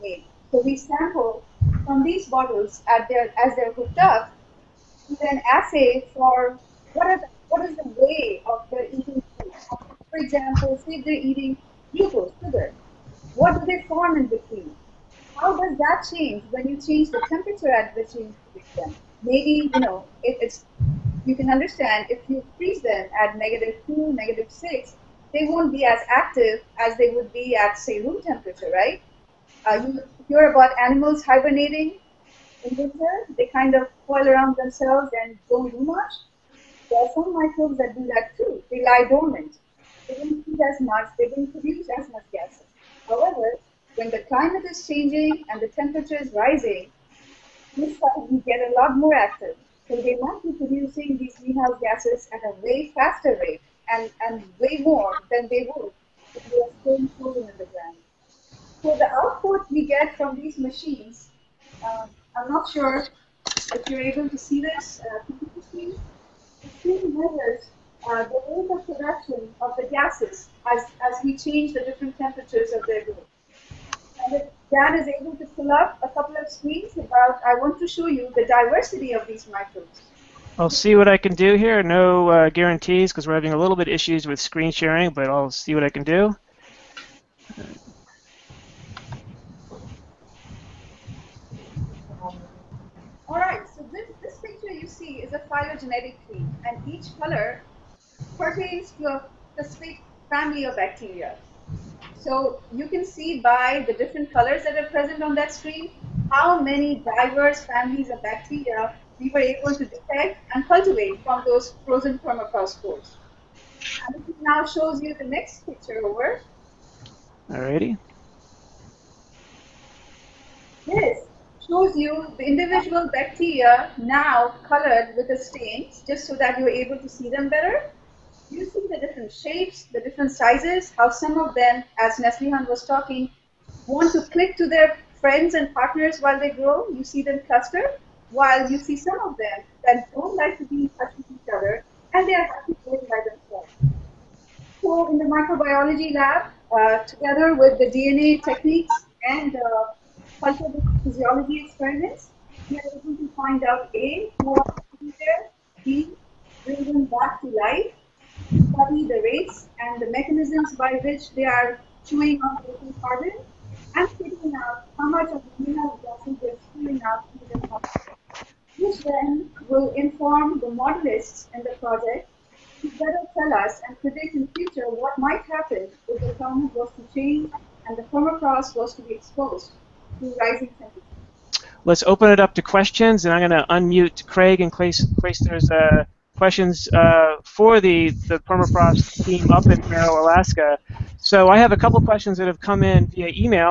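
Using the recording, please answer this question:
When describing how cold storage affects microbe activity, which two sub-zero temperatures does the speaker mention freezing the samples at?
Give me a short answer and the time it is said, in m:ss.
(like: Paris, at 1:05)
-2 and -6, at 0:23.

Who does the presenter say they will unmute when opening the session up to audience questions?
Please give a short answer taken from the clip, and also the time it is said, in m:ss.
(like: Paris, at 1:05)
Craig, at 3:04.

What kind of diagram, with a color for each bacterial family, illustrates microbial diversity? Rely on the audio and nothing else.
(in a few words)
Phylogenetic tree.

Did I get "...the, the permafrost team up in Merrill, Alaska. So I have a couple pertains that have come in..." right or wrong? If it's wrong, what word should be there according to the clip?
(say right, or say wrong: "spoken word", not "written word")
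wrong: "questions", not "pertains".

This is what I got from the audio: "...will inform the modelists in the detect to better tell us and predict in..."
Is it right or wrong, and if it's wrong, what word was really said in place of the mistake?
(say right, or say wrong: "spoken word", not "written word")
wrong: "project", not "detect".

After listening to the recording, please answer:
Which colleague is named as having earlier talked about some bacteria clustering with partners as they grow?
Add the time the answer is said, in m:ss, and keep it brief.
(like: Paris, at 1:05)
Neslihan, at 2:12.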